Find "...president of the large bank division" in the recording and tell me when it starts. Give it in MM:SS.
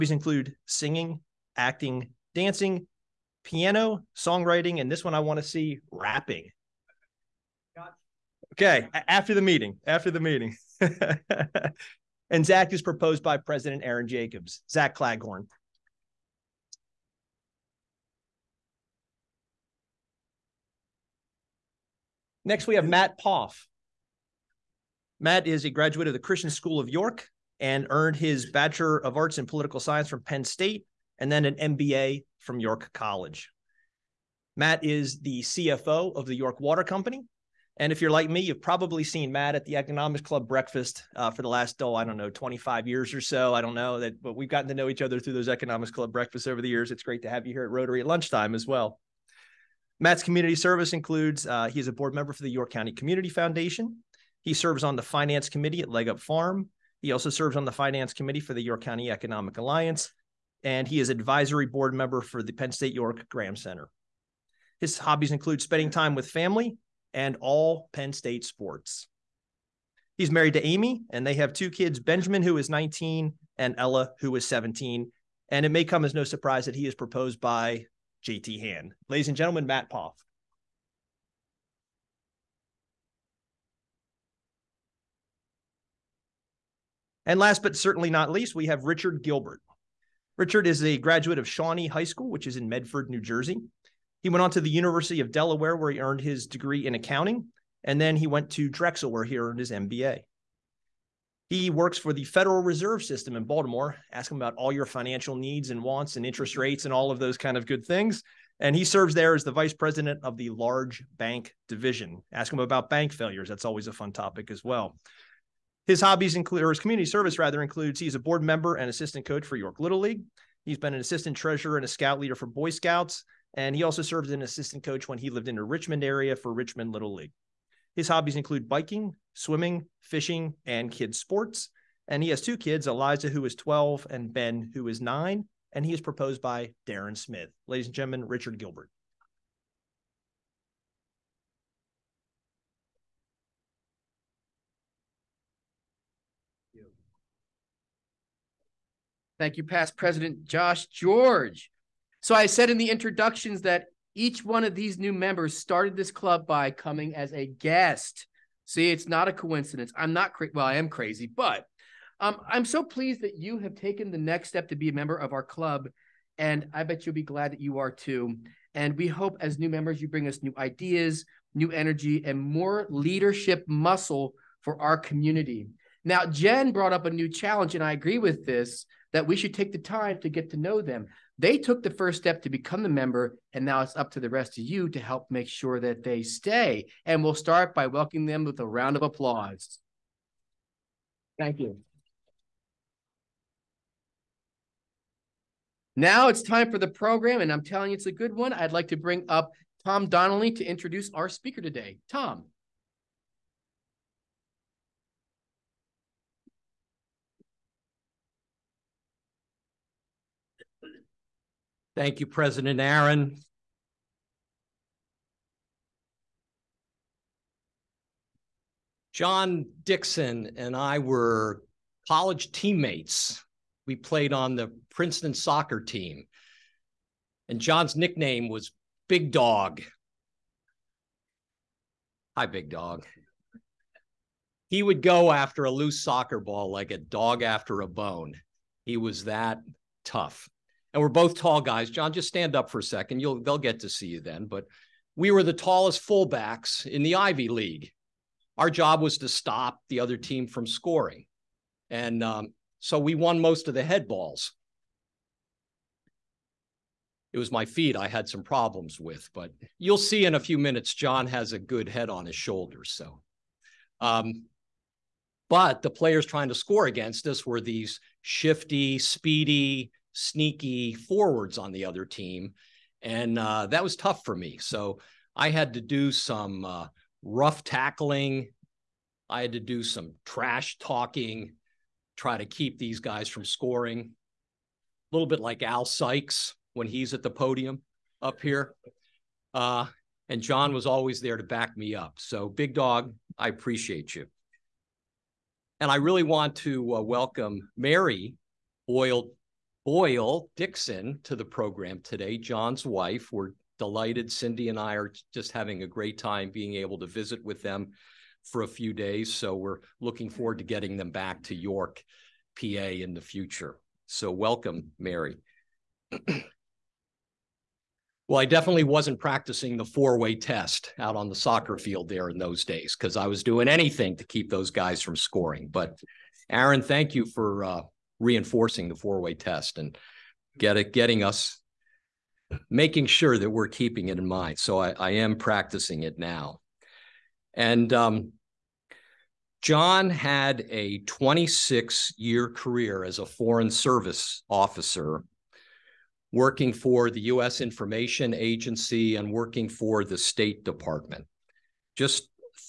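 01:49.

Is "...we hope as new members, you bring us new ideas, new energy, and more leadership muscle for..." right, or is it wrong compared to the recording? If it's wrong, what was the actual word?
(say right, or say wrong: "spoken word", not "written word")
right.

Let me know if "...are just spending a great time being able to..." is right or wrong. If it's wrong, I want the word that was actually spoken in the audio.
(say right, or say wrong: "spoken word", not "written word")
wrong: "having", not "spending".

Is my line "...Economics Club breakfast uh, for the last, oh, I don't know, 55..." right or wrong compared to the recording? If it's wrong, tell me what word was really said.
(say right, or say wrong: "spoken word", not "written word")
wrong: "25", not "55".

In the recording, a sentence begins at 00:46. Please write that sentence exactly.
It's great to have you here at Rotary at lunchtime as well.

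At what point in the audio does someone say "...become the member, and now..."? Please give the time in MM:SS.
03:02.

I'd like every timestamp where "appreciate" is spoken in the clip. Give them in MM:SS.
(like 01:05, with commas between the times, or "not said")
04:53.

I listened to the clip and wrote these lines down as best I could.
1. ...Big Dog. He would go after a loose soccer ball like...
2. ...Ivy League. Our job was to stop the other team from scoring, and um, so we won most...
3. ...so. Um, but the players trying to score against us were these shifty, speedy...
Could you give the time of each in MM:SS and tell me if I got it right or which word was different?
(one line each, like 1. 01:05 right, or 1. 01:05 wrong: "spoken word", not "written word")
1. 03:52 right
2. 04:07 right
3. 04:22 right.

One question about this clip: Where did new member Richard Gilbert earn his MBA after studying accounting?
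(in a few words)
Drexel.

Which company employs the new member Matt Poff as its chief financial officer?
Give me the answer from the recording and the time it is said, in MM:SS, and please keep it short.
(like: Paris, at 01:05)
York Water Company, at 00:36.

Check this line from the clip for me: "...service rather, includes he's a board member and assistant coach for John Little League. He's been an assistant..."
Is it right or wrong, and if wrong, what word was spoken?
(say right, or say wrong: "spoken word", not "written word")
wrong: "York", not "John".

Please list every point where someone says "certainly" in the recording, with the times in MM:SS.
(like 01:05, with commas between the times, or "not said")
01:27.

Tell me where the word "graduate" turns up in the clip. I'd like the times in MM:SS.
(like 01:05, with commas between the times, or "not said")
00:25, 01:30.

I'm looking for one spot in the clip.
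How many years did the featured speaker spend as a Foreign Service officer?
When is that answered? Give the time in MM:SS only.
05:41.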